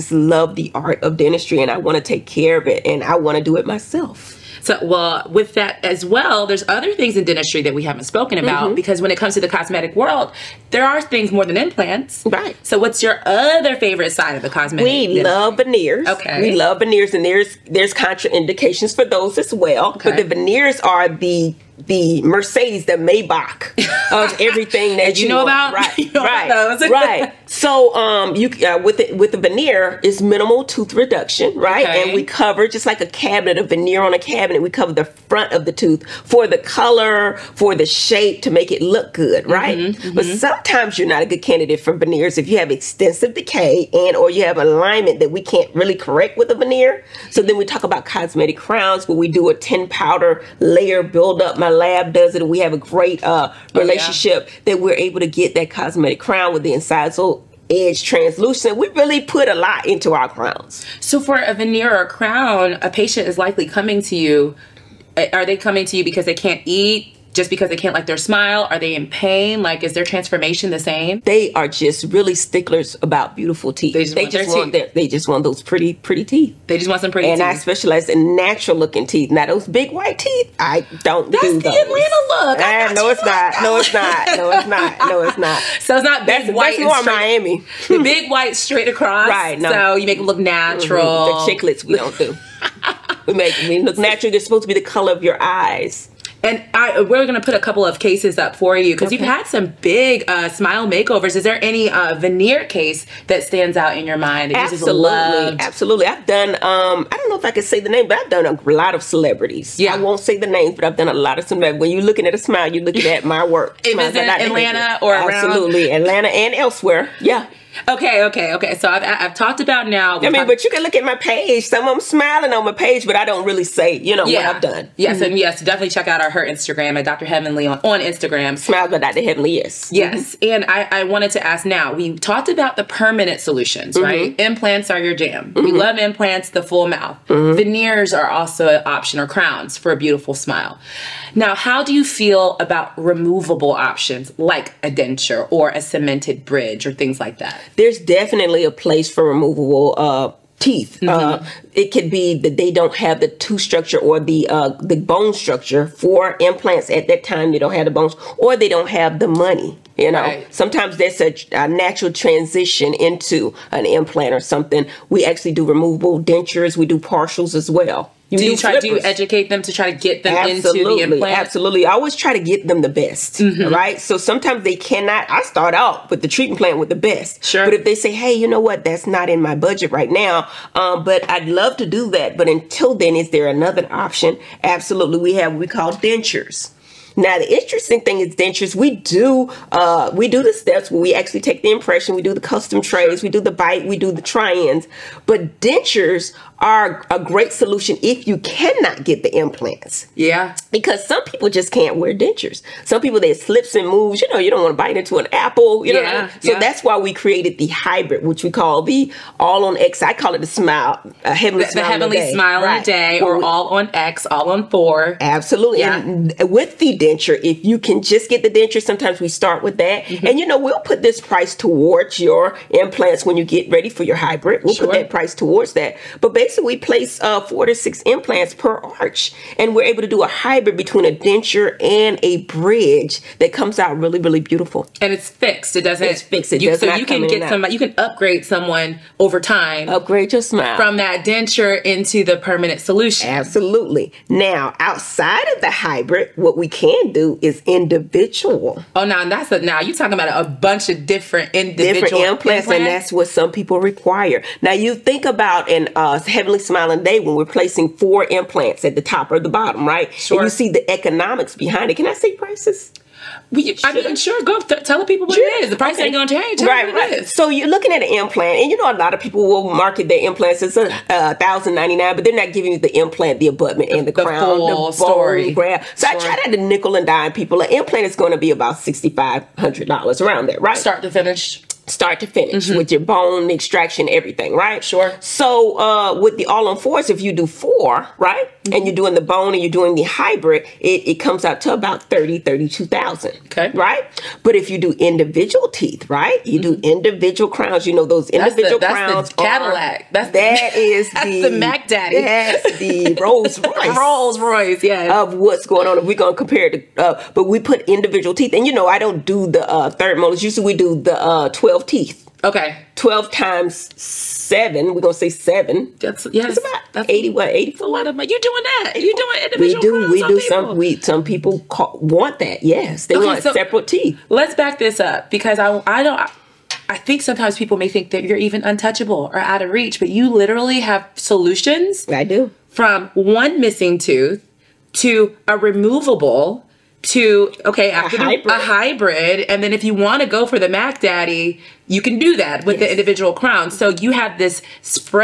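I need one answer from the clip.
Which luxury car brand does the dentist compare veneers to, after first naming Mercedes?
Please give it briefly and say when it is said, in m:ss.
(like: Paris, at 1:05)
Maybach, at 0:22.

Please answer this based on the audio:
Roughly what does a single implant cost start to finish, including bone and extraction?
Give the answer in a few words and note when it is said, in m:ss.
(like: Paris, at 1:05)
$6,500, at 4:38.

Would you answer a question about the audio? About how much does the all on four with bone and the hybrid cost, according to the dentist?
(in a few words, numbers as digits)
30,000 to 32,000.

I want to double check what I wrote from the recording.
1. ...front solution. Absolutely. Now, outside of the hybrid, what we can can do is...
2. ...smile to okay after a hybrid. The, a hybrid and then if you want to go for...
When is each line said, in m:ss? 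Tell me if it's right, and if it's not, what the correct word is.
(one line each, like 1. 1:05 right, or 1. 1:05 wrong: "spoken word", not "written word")
1. 4:02 wrong: "permanent", not "front"
2. 5:35 wrong: "removable", not "smile".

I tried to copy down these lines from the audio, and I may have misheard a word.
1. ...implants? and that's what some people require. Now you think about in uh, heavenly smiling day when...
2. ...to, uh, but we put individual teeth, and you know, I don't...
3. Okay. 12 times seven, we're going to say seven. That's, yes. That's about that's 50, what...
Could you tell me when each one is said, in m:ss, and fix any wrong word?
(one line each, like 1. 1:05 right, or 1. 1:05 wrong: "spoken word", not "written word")
1. 4:12 right
2. 5:06 right
3. 5:12 wrong: "80", not "50".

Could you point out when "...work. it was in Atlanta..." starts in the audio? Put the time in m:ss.
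1:53.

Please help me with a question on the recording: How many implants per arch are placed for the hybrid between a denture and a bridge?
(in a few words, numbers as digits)
4 to 6.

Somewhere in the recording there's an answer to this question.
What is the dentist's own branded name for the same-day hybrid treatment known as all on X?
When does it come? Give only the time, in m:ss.
3:31.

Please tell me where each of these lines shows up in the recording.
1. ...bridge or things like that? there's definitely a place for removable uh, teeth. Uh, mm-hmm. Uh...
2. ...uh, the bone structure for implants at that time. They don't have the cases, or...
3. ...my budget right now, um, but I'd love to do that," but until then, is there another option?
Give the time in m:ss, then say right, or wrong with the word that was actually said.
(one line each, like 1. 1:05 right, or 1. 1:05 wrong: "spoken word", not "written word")
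1. 2:26 right
2. 2:34 wrong: "bones", not "cases"
3. 2:59 right.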